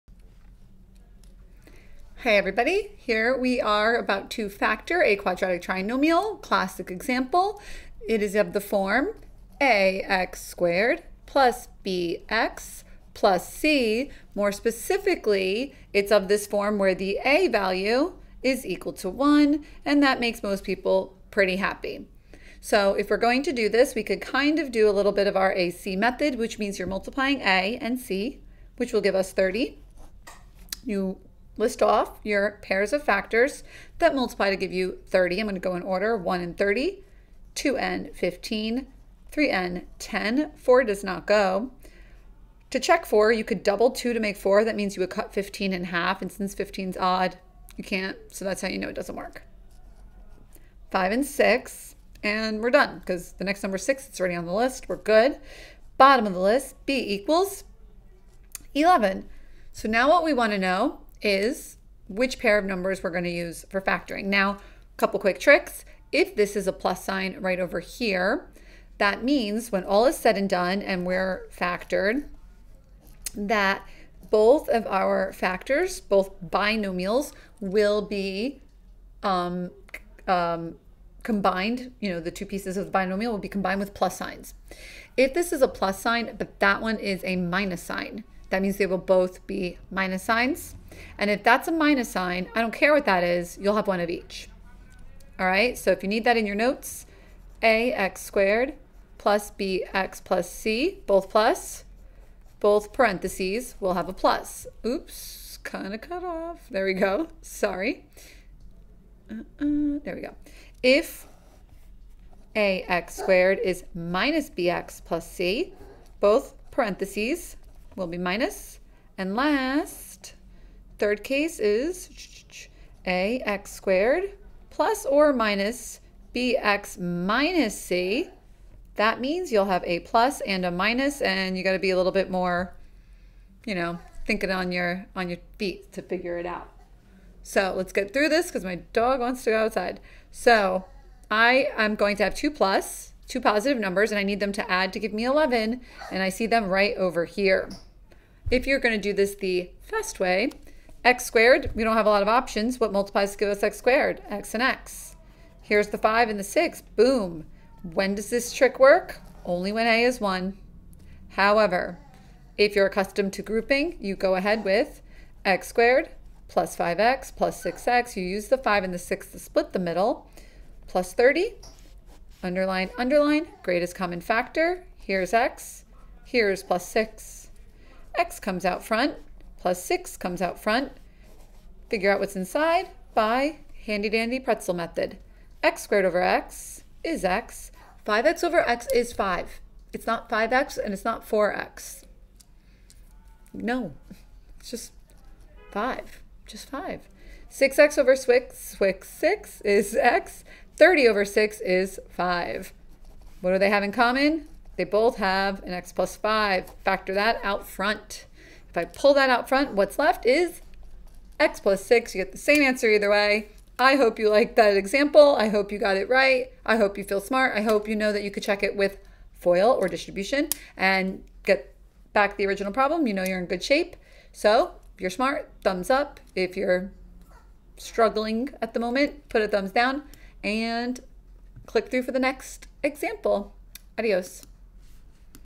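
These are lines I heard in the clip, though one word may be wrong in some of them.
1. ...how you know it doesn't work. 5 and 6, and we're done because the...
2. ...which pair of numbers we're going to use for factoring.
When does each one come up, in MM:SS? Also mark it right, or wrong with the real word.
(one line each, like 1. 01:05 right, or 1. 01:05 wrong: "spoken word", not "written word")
1. 00:48 right
2. 01:02 right.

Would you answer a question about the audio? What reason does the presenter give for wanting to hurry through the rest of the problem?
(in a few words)
dog wants to go outside.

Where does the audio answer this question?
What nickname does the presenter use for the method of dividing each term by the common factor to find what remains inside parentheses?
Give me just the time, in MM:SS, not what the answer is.
03:04.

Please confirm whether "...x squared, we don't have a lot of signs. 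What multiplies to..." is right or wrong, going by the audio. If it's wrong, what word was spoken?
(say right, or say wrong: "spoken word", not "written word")
wrong: "options", not "signs".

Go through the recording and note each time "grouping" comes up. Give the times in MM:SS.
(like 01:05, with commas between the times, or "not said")
02:43.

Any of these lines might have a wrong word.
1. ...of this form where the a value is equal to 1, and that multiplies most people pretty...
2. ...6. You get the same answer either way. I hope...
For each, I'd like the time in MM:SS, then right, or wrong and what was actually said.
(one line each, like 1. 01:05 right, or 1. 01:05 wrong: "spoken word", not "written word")
1. 00:16 wrong: "makes", not "multiplies"
2. 03:31 right.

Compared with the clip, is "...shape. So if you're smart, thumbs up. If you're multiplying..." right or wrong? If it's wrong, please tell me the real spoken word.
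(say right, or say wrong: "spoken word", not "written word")
wrong: "struggling", not "multiplying".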